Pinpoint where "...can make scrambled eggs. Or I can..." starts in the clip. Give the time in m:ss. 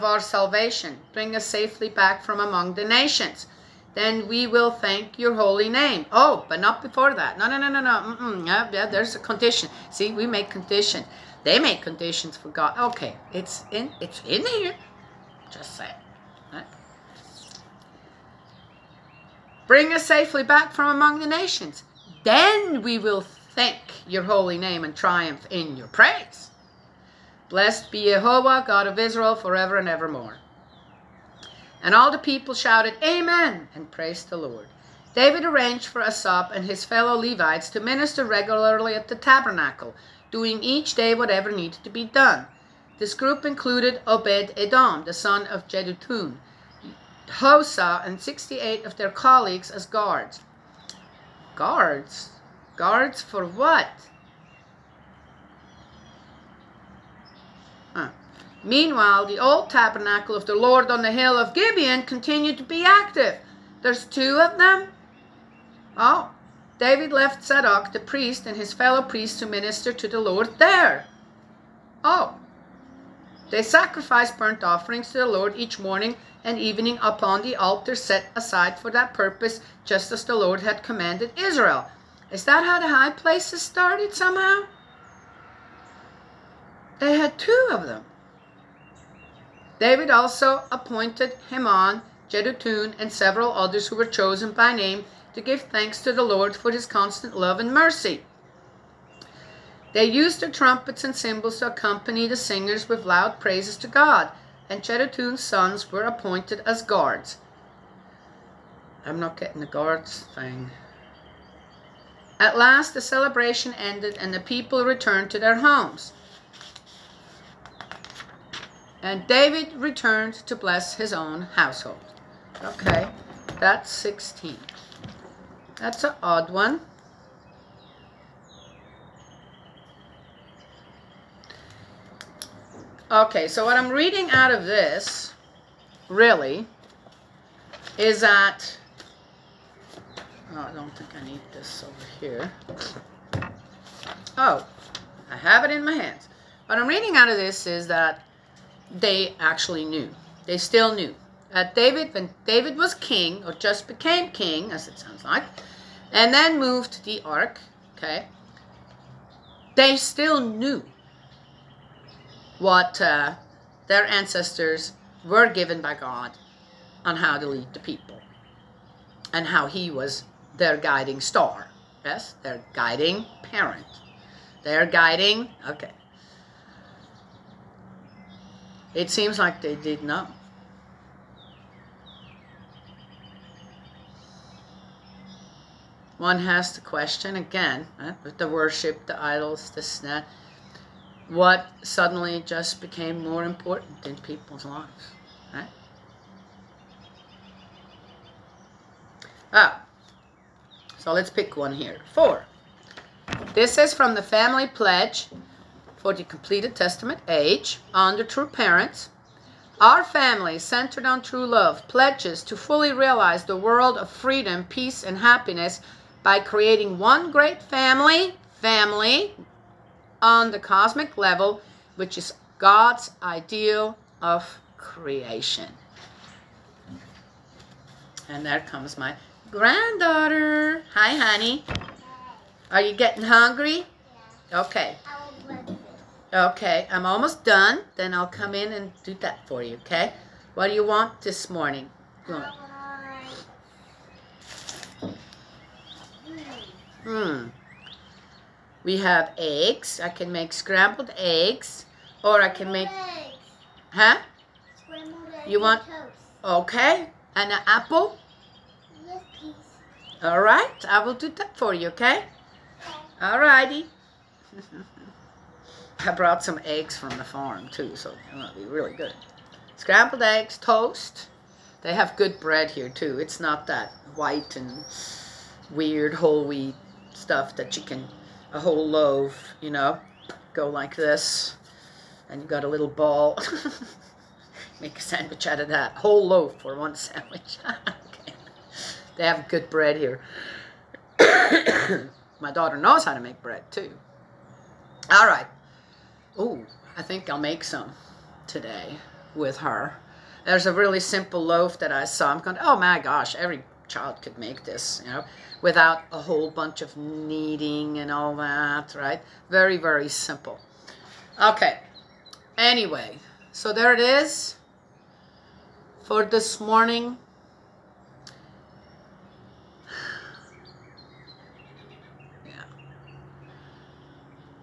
4:10.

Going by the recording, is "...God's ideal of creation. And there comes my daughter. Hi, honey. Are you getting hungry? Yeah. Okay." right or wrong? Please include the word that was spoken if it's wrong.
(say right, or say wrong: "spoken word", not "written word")
wrong: "granddaughter", not "daughter".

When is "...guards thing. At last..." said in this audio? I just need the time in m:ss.
1:49.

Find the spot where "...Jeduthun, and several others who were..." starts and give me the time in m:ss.
1:32.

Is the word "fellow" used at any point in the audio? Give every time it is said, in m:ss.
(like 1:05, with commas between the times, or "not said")
0:36, 1:08.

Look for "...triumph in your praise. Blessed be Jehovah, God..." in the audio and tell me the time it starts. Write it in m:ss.
0:24.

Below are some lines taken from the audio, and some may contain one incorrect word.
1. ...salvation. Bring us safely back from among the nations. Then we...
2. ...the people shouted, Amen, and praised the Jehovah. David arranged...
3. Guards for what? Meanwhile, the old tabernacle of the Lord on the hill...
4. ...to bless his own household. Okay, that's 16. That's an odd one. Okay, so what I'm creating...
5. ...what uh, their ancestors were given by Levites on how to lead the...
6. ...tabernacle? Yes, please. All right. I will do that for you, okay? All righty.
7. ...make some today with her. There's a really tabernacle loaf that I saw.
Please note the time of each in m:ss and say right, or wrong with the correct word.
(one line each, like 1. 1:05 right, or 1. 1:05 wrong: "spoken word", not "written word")
1. 0:00 right
2. 0:32 wrong: "Lord", not "Jehovah"
3. 0:52 right
4. 2:00 wrong: "reading", not "creating"
5. 2:42 wrong: "God", not "Levites"
6. 4:17 wrong: "apple", not "tabernacle"
7. 4:57 wrong: "simple", not "tabernacle".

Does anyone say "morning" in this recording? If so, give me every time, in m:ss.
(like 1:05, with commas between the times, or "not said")
1:15, 4:01, 5:16.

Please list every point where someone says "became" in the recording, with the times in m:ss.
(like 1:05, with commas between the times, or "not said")
2:33, 3:12.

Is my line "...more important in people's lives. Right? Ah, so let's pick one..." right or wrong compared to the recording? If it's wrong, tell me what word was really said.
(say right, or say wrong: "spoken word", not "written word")
right.